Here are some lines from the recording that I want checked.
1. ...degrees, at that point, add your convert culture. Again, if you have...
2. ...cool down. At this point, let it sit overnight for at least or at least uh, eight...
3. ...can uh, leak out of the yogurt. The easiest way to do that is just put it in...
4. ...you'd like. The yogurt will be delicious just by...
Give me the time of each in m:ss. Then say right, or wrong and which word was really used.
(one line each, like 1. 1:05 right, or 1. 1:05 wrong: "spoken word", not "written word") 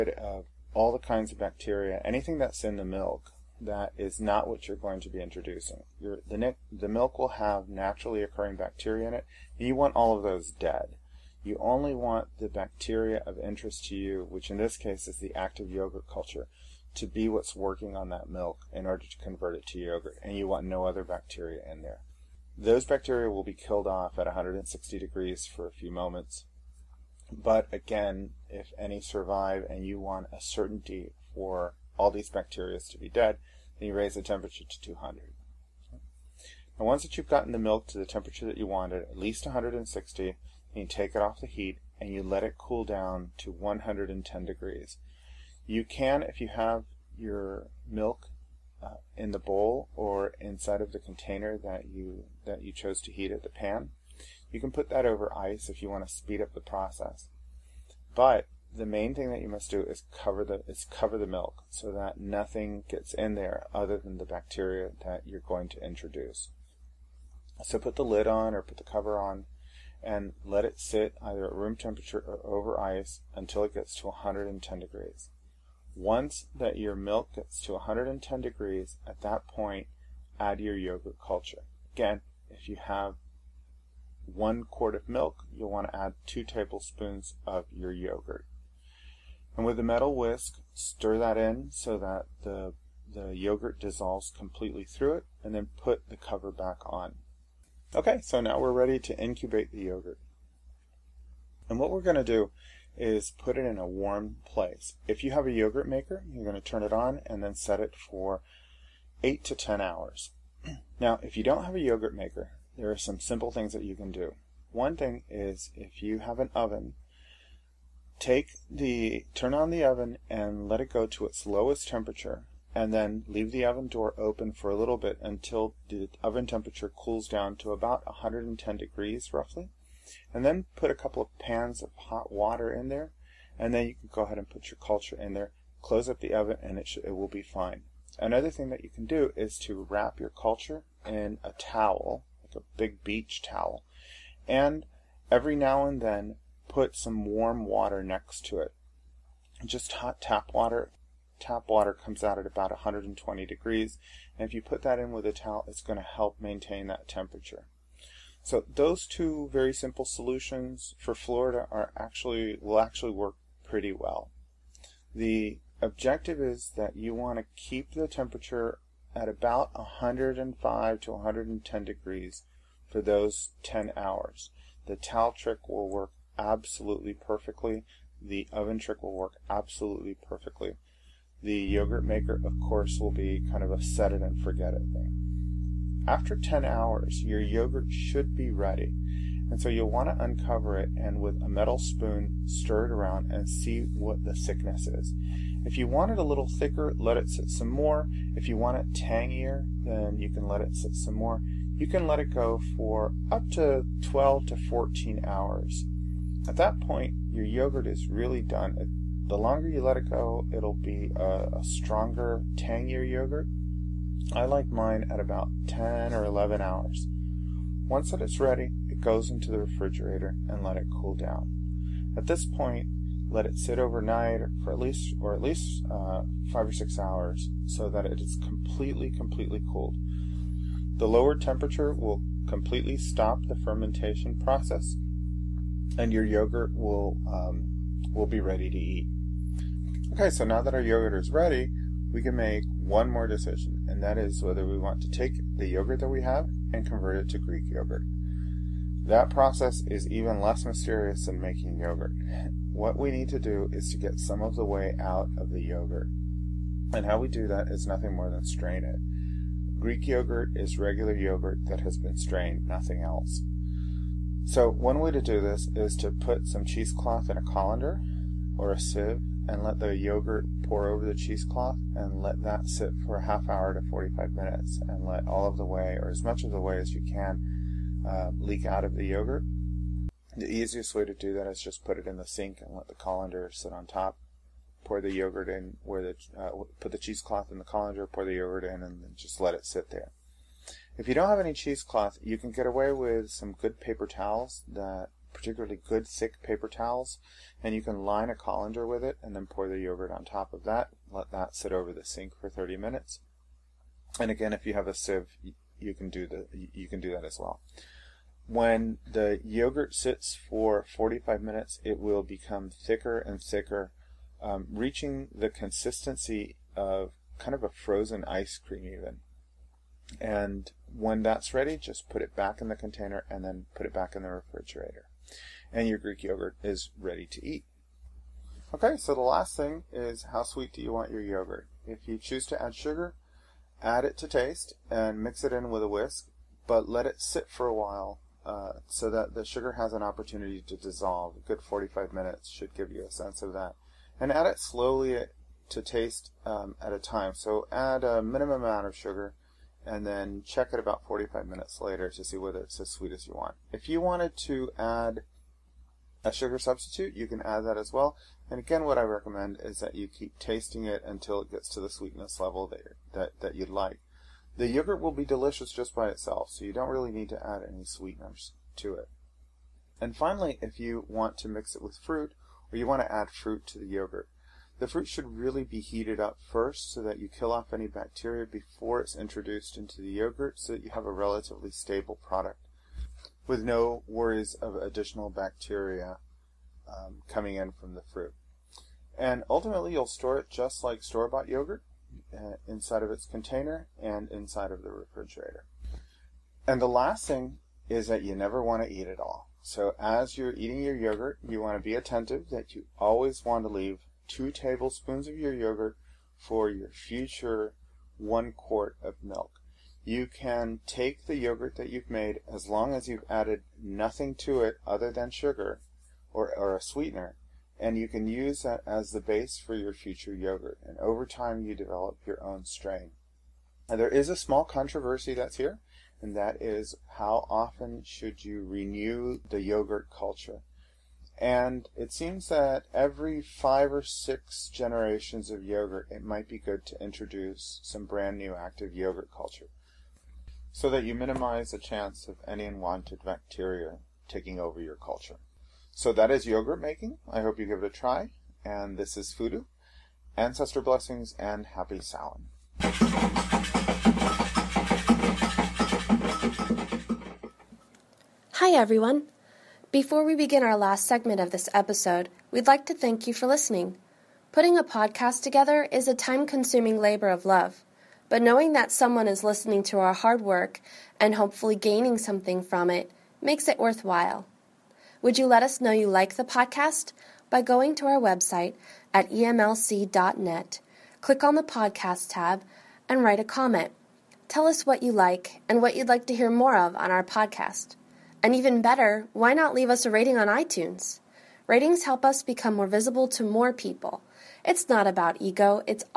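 1. 1:18 wrong: "yogurt", not "convert"
2. 3:40 wrong: "five", not "eight"
3. 4:37 right
4. 6:03 right.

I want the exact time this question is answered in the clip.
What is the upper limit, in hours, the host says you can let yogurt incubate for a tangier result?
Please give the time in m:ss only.
3:24.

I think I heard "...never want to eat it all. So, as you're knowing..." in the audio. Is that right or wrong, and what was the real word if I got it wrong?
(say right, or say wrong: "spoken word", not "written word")
wrong: "eating", not "knowing".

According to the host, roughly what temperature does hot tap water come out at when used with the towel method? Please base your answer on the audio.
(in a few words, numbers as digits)
120 degrees.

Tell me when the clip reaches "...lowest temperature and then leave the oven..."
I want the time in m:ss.
2:01.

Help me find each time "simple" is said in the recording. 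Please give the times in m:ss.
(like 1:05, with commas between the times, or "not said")
1:53, 2:39.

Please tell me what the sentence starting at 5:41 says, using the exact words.
A good 45 minutes should give you a sense of that.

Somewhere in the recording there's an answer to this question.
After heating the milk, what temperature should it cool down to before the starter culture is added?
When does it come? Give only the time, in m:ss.
0:42.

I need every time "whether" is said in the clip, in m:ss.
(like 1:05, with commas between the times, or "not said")
4:04, 5:52.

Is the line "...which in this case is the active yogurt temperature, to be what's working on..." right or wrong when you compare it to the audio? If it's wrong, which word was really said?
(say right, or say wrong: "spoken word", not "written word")
wrong: "culture", not "temperature".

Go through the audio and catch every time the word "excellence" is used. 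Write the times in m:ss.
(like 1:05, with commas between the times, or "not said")
not said.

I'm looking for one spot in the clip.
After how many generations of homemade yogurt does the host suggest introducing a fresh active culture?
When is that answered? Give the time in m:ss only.
7:13.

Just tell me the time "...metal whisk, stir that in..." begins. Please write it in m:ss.
1:29.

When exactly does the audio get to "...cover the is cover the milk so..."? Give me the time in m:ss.
1:00.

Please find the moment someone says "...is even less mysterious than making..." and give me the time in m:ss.
4:09.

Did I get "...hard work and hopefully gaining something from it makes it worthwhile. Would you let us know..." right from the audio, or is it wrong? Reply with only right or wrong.
right.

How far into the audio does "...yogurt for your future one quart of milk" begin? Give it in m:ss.
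6:45.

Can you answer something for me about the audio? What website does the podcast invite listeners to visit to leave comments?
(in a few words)
emlc.net.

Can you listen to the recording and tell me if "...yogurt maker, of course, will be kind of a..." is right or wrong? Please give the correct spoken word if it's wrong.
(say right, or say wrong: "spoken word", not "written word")
right.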